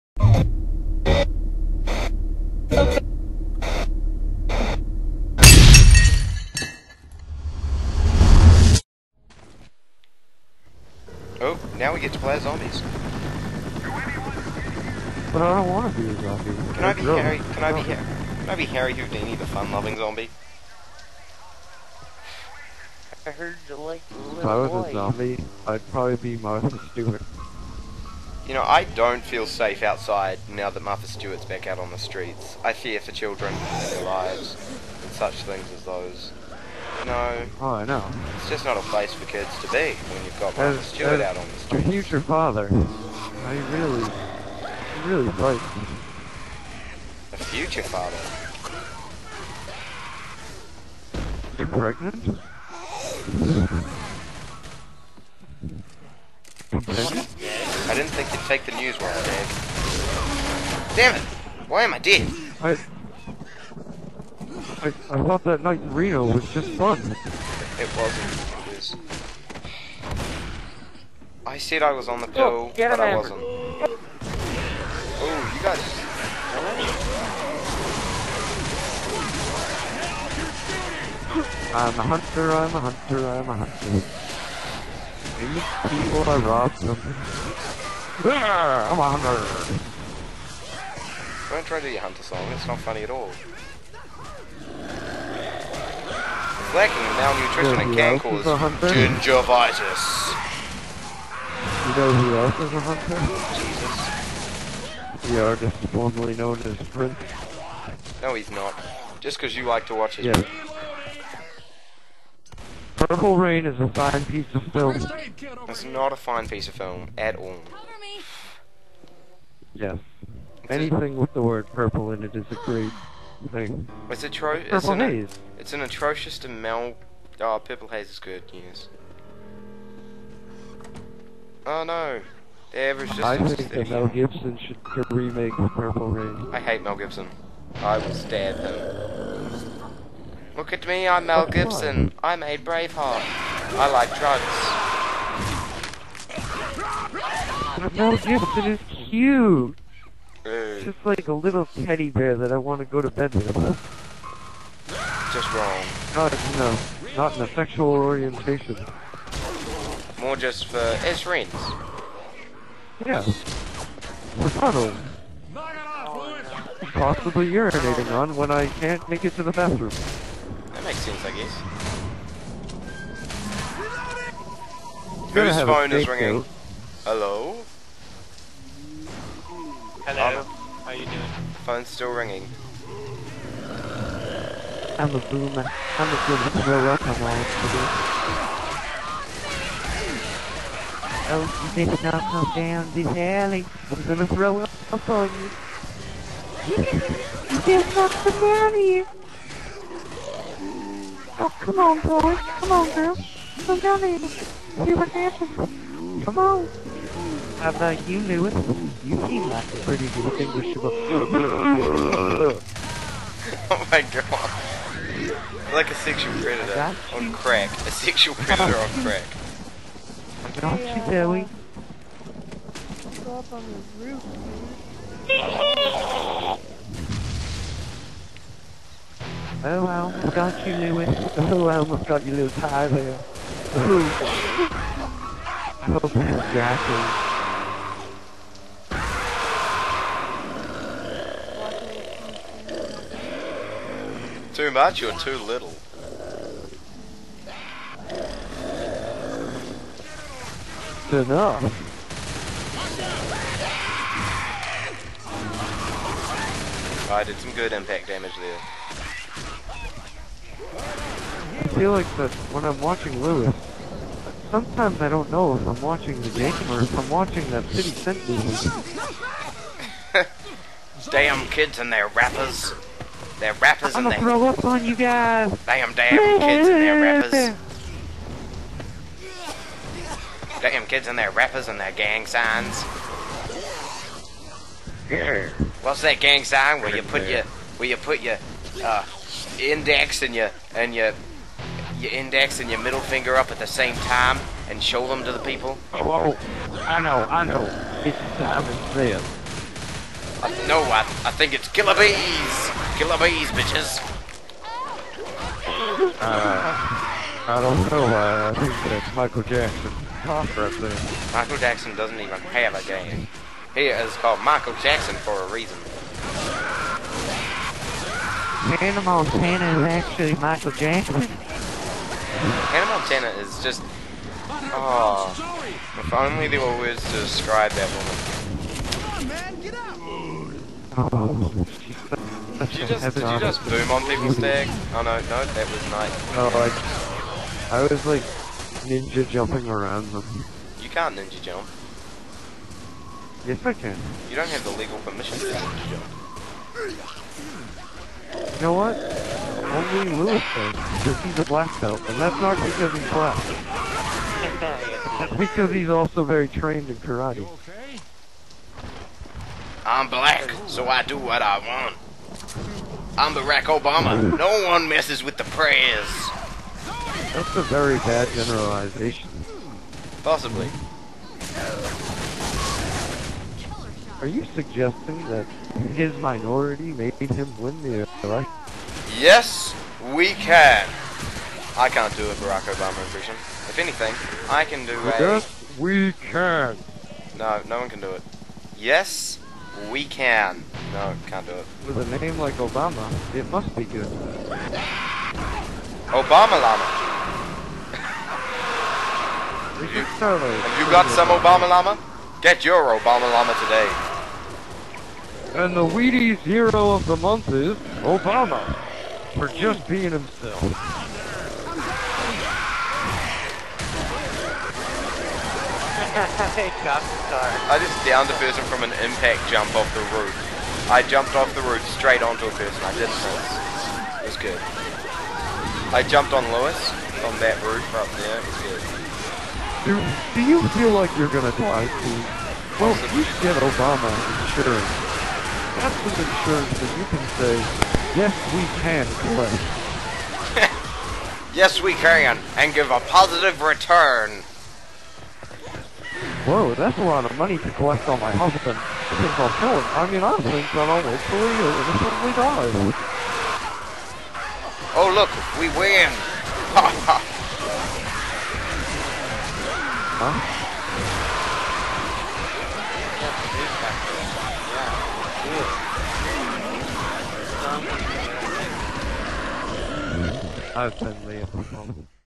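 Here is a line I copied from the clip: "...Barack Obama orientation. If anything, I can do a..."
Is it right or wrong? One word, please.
wrong.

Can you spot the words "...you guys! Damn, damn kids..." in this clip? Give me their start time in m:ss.
4:34.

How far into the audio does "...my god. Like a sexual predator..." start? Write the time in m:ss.
3:33.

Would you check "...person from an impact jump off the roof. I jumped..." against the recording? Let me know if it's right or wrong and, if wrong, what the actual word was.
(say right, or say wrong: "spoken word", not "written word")
right.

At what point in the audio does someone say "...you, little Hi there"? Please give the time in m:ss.
3:52.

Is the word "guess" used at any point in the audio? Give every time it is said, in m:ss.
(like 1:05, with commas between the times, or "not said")
2:51.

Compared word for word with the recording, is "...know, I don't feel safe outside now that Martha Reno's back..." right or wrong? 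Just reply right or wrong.
wrong.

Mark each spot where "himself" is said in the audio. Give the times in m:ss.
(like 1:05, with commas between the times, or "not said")
6:50.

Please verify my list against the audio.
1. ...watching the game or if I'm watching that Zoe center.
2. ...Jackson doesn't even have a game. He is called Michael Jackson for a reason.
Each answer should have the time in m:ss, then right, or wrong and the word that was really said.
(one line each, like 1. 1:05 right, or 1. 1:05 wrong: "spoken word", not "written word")
1. 4:25 wrong: "City", not "Zoe"
2. 5:11 right.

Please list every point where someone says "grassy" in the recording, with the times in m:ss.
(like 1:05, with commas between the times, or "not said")
3:56.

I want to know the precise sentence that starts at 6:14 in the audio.
Are you suggesting that his minority made him win the election?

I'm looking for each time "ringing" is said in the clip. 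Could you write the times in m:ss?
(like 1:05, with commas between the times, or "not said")
2:56, 3:02.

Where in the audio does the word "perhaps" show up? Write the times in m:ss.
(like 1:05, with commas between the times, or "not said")
not said.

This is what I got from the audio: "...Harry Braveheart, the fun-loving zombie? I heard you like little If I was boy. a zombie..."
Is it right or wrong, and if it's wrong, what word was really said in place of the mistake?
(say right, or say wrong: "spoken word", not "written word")
wrong: "Houdini", not "Braveheart".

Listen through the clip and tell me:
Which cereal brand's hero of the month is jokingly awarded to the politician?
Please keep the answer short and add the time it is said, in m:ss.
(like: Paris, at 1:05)
Wheaties, at 6:45.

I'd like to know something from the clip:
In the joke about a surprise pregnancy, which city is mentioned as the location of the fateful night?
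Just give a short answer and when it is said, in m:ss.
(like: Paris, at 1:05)
Reno, at 1:05.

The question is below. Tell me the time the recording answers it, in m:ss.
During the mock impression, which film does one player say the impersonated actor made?
2:22.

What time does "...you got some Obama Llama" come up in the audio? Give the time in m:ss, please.
6:40.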